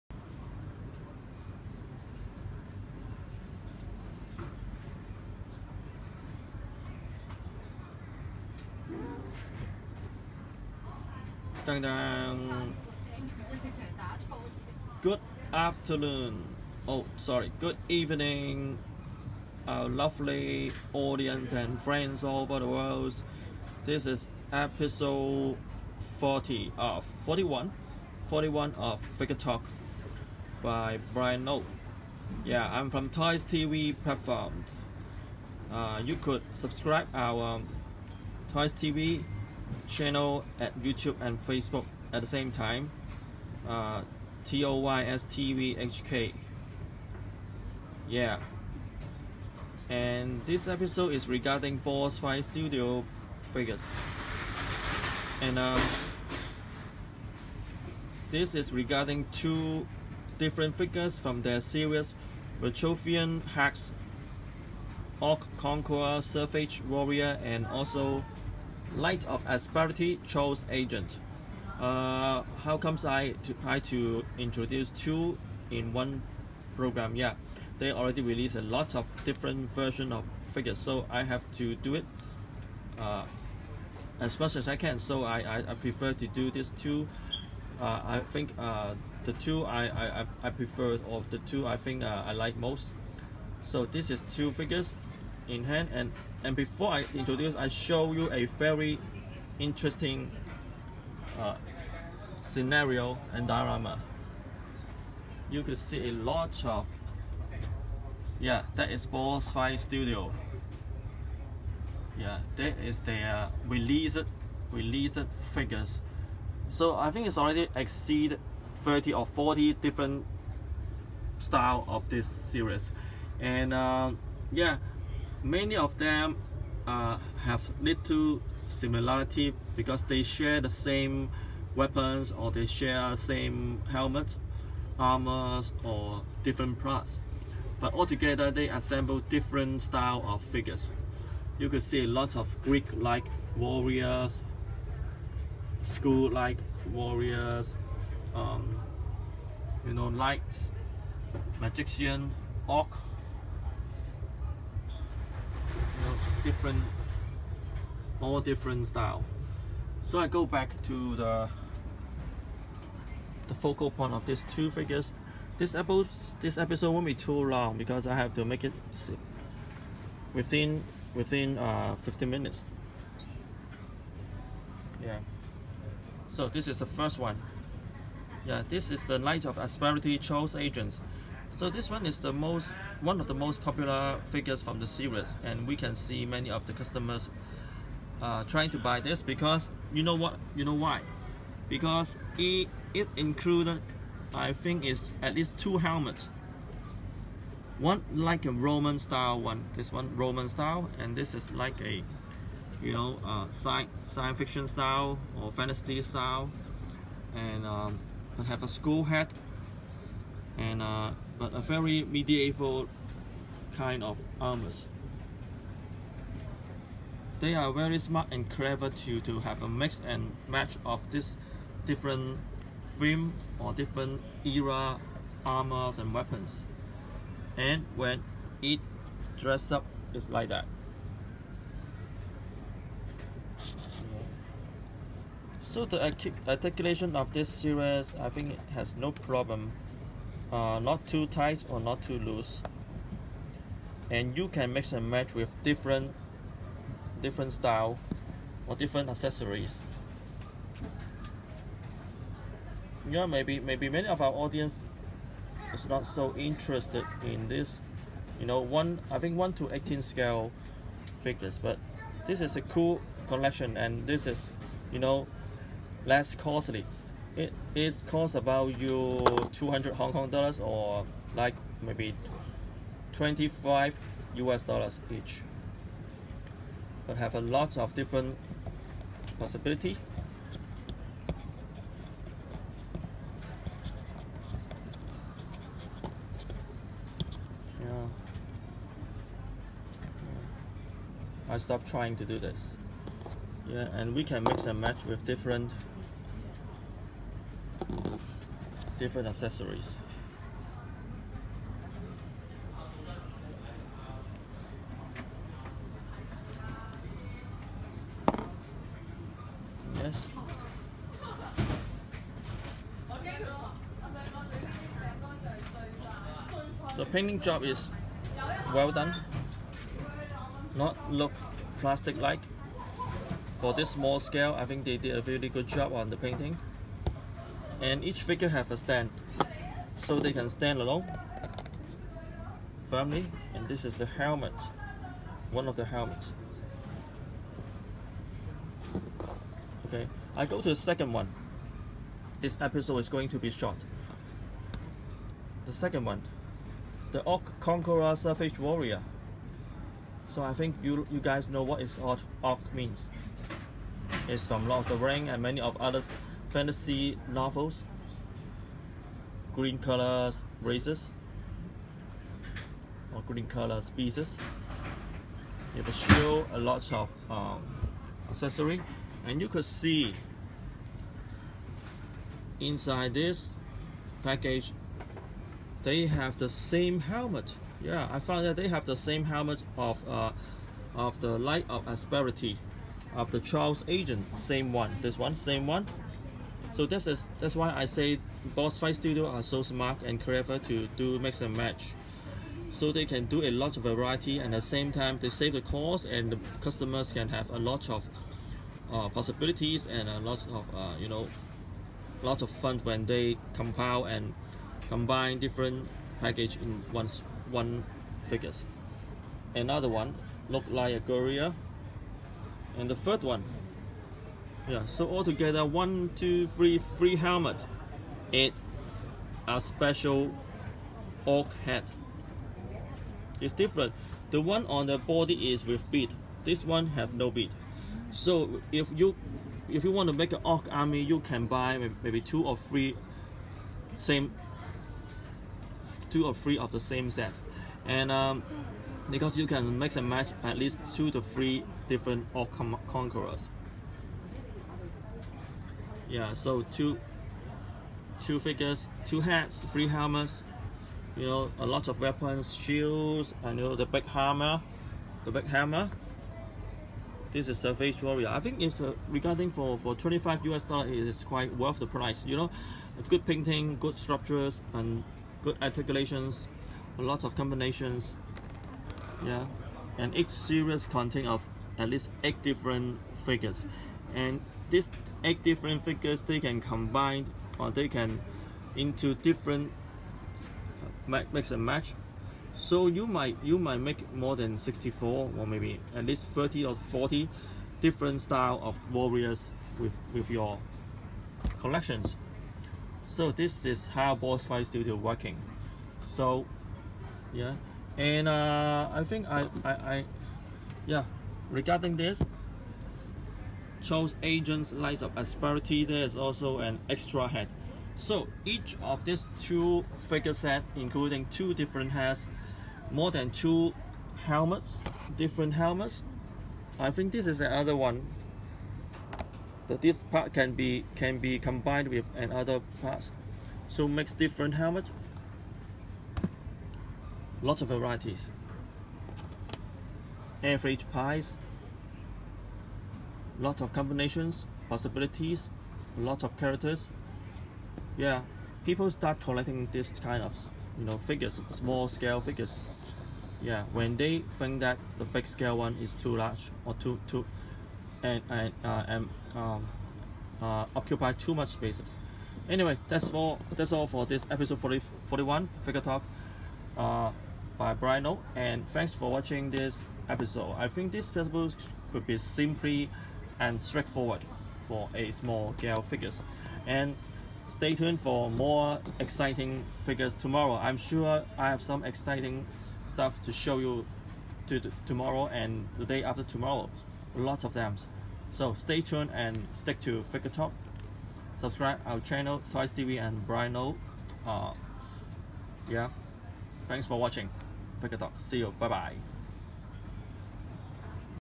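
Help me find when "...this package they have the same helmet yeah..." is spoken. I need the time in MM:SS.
06:13.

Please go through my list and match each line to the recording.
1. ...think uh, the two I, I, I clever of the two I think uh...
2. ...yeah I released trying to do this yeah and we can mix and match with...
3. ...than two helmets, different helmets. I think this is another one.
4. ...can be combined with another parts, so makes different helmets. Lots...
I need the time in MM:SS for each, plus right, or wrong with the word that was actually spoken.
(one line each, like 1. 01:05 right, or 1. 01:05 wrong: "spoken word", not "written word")
1. 01:28 wrong: "prefer", not "clever"
2. 04:47 wrong: "stopped", not "released"
3. 08:33 right
4. 08:40 right.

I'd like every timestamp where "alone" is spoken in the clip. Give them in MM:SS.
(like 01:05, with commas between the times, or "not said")
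05:30.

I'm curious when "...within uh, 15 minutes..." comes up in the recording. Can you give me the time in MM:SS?
02:51.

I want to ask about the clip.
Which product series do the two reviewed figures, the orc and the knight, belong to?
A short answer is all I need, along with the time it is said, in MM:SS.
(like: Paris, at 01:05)
Vitruvian Hacks, at 01:02.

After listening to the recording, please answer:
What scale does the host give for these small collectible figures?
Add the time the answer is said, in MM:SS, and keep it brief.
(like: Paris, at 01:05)
1 to 18, at 04:19.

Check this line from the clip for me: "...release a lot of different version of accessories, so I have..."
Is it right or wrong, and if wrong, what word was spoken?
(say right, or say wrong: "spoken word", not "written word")
wrong: "figures", not "accessories".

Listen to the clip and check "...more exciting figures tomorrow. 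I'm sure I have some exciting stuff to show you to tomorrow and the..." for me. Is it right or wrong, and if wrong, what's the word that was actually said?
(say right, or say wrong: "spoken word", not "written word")
right.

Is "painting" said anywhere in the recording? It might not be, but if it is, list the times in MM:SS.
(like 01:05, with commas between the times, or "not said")
05:17, 05:26, 07:43.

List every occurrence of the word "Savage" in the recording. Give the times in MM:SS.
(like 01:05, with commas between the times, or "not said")
01:06, 05:48, 07:37.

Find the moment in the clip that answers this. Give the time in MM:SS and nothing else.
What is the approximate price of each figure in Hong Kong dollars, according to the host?
04:29.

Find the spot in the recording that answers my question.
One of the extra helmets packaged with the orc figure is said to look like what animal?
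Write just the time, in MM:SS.
06:50.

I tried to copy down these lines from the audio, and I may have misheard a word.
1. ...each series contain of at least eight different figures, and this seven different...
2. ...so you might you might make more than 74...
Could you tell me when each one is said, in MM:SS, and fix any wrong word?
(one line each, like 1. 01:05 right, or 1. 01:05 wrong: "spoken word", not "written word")
1. 07:50 wrong: "eight", not "seven"
2. 08:02 wrong: "64", not "74".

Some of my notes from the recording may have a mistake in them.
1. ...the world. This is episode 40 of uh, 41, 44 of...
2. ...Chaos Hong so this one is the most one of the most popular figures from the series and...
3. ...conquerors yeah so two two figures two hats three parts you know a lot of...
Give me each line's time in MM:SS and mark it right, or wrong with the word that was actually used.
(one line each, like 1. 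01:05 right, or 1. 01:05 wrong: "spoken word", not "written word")
1. 00:22 wrong: "41", not "44"
2. 03:00 wrong: "Agents", not "Hong"
3. 07:22 wrong: "helmets", not "parts".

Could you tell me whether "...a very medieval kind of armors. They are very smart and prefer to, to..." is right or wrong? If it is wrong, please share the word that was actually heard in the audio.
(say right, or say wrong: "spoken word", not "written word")
wrong: "clever", not "prefer".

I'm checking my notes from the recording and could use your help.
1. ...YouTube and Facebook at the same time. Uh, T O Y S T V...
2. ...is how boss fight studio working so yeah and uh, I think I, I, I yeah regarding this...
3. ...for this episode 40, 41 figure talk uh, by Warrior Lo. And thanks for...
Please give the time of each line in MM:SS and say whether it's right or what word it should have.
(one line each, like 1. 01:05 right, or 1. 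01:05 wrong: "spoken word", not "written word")
1. 00:40 right
2. 08:13 right
3. 09:13 wrong: "Bryan", not "Warrior".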